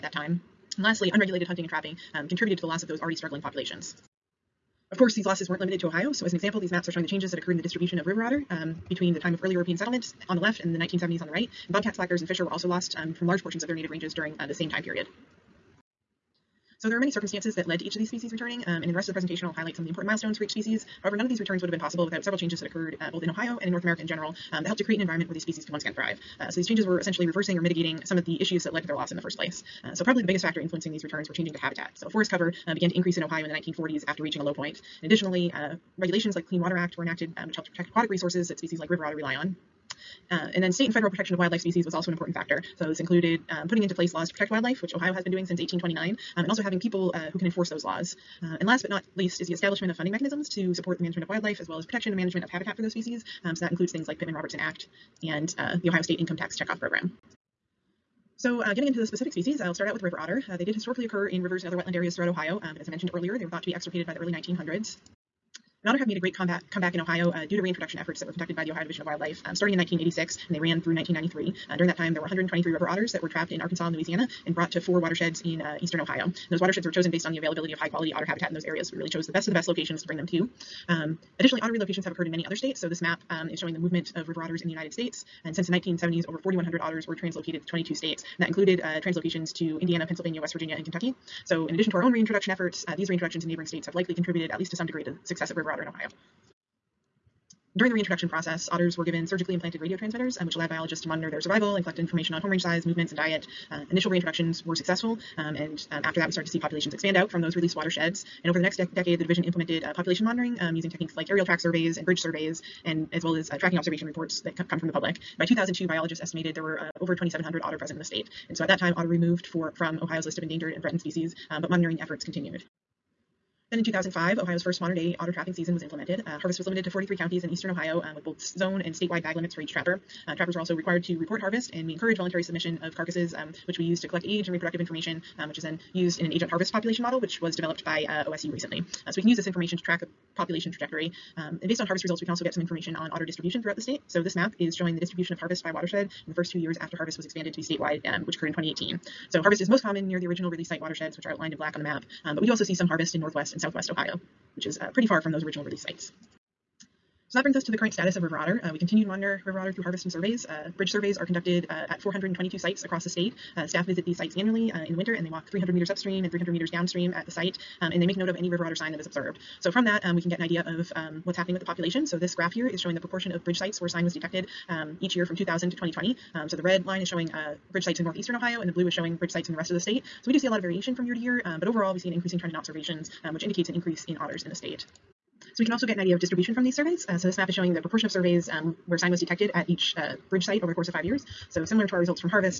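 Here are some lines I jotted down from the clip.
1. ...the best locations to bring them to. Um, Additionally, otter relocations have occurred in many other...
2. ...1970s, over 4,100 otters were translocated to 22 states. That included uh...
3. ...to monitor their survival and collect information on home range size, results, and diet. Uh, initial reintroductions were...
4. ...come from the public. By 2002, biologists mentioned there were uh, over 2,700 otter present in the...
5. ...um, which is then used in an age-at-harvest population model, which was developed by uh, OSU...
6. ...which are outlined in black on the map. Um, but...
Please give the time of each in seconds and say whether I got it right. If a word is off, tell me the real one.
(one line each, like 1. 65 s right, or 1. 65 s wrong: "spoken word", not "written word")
1. 79 s right
2. 85 s right
3. 101 s wrong: "movements", not "results"
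4. 114 s wrong: "estimated", not "mentioned"
5. 135 s right
6. 151 s right.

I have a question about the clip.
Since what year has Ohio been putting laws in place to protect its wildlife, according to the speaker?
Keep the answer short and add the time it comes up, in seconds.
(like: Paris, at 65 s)
1829, at 45 s.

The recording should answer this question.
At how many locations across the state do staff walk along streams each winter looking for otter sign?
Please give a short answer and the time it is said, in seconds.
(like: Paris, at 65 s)
422, at 161 s.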